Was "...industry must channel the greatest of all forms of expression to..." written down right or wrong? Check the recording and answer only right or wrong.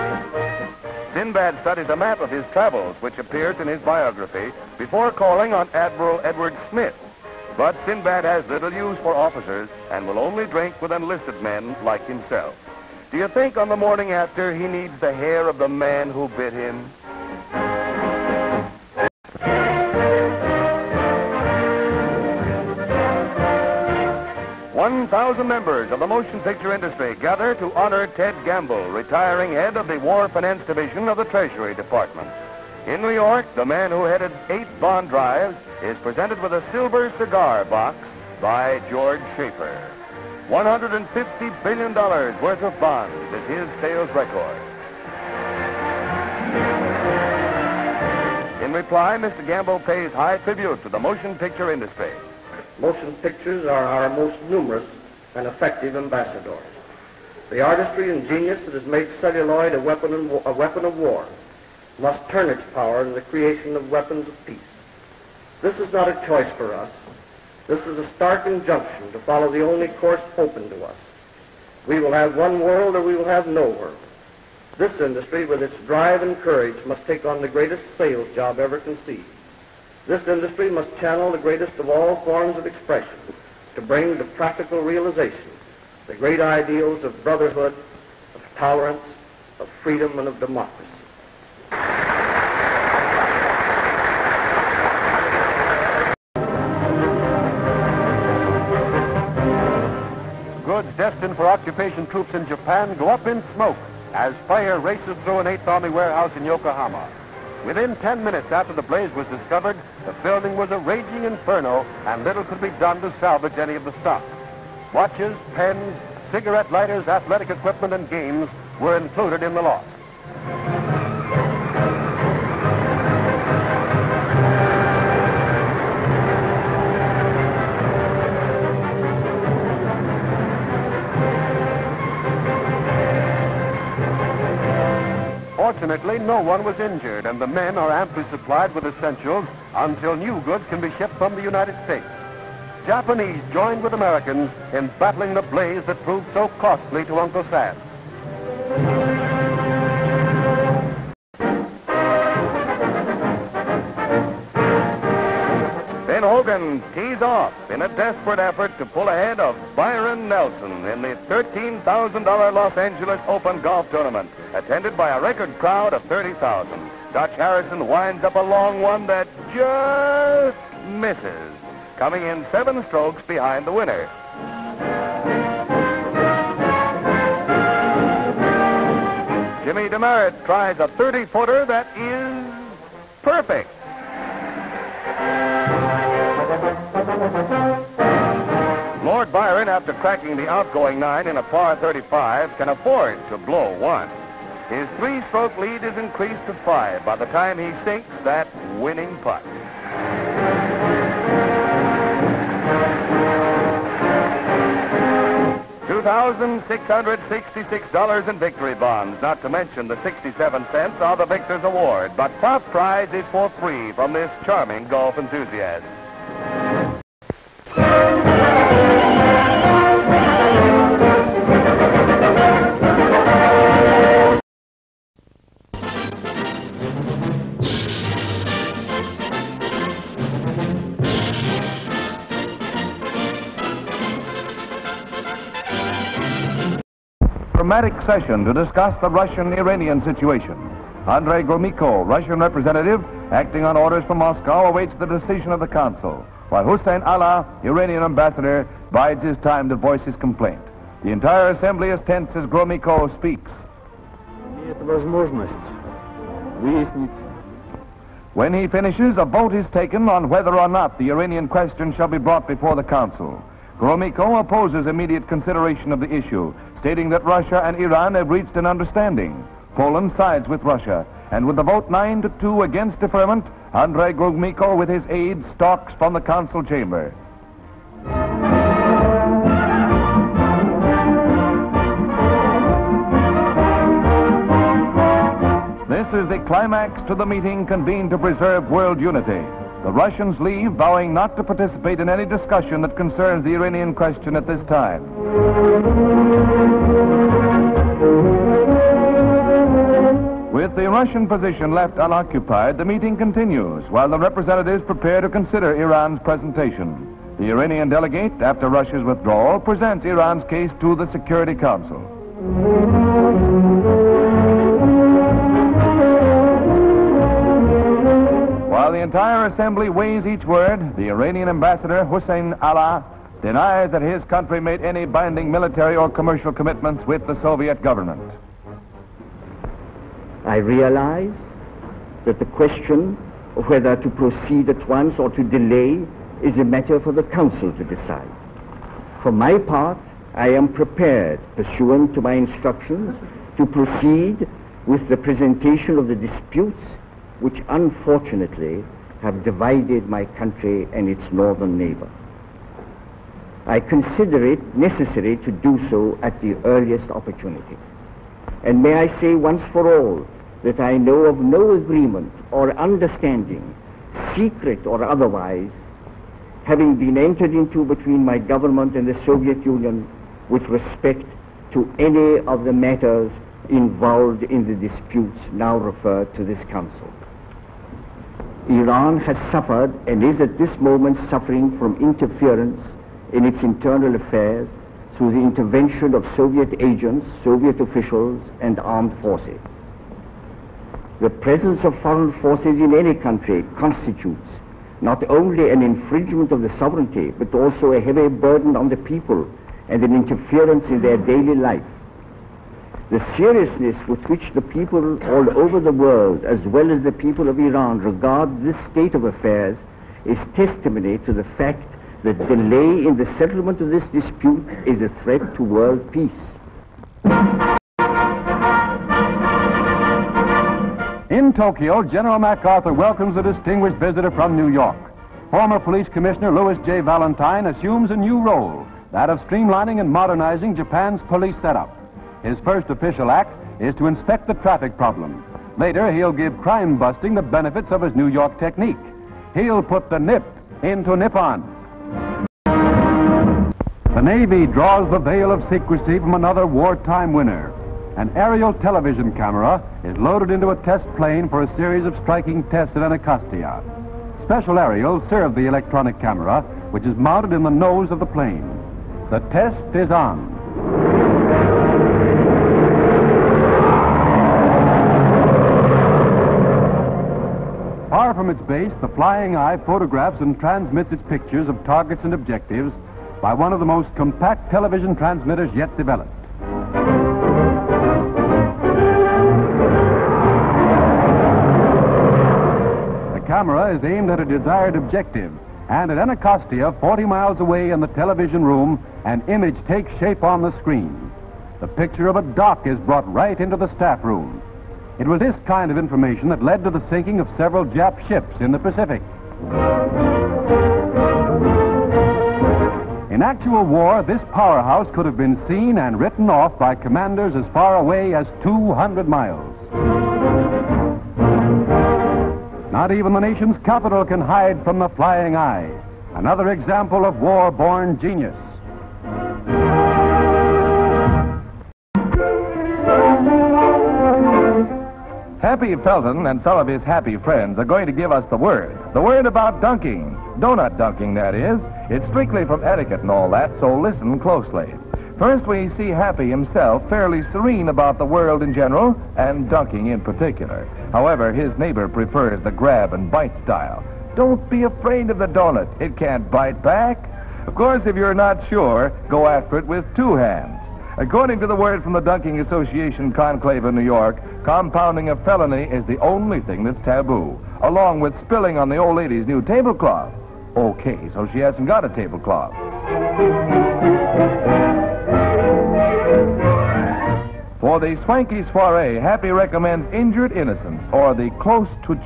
right.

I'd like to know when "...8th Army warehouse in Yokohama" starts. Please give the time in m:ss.
1:45.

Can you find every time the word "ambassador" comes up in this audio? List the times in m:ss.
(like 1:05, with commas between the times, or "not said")
0:55, 4:08, 5:21.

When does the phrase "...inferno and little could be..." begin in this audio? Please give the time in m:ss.
1:51.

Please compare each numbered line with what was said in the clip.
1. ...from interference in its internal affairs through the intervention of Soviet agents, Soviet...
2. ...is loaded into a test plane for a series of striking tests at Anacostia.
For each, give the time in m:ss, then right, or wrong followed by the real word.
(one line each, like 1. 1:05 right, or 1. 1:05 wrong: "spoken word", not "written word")
1. 6:21 right
2. 7:30 right.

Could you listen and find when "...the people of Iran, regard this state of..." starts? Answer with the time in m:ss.
6:47.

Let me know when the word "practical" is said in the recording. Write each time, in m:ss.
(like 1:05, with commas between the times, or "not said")
1:24.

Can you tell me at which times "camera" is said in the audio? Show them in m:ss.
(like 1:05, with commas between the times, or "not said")
7:29, 7:36, 8:03.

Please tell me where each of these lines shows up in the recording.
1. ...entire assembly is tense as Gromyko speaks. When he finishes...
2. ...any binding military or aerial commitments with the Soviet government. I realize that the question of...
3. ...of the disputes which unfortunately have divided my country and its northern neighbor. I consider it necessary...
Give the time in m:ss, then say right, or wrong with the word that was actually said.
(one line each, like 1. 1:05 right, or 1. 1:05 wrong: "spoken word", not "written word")
1. 4:11 right
2. 5:24 wrong: "commercial", not "aerial"
3. 5:45 right.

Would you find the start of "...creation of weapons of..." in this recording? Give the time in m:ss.
1:03.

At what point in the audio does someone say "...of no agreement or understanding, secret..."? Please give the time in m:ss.
6:01.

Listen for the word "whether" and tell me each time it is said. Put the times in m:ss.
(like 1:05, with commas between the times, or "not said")
4:20, 5:33.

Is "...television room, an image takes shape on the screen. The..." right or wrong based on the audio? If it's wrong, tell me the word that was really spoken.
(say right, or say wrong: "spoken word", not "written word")
right.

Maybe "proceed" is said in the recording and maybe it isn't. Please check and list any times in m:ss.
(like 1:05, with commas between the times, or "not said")
5:34, 5:43.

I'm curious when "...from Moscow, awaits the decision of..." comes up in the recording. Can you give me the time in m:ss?
4:04.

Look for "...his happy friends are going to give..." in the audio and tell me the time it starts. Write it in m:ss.
8:46.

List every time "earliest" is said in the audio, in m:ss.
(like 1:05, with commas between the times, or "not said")
5:56.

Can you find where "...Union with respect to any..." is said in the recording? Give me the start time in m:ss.
6:09.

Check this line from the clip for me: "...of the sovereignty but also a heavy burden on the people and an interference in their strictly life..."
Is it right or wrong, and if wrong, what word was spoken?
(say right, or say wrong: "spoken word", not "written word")
wrong: "daily", not "strictly".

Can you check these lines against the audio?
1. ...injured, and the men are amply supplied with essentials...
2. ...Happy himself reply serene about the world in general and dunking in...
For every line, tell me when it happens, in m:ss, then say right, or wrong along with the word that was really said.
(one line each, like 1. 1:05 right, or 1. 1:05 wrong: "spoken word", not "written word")
1. 2:16 right
2. 8:56 wrong: "fairly", not "reply".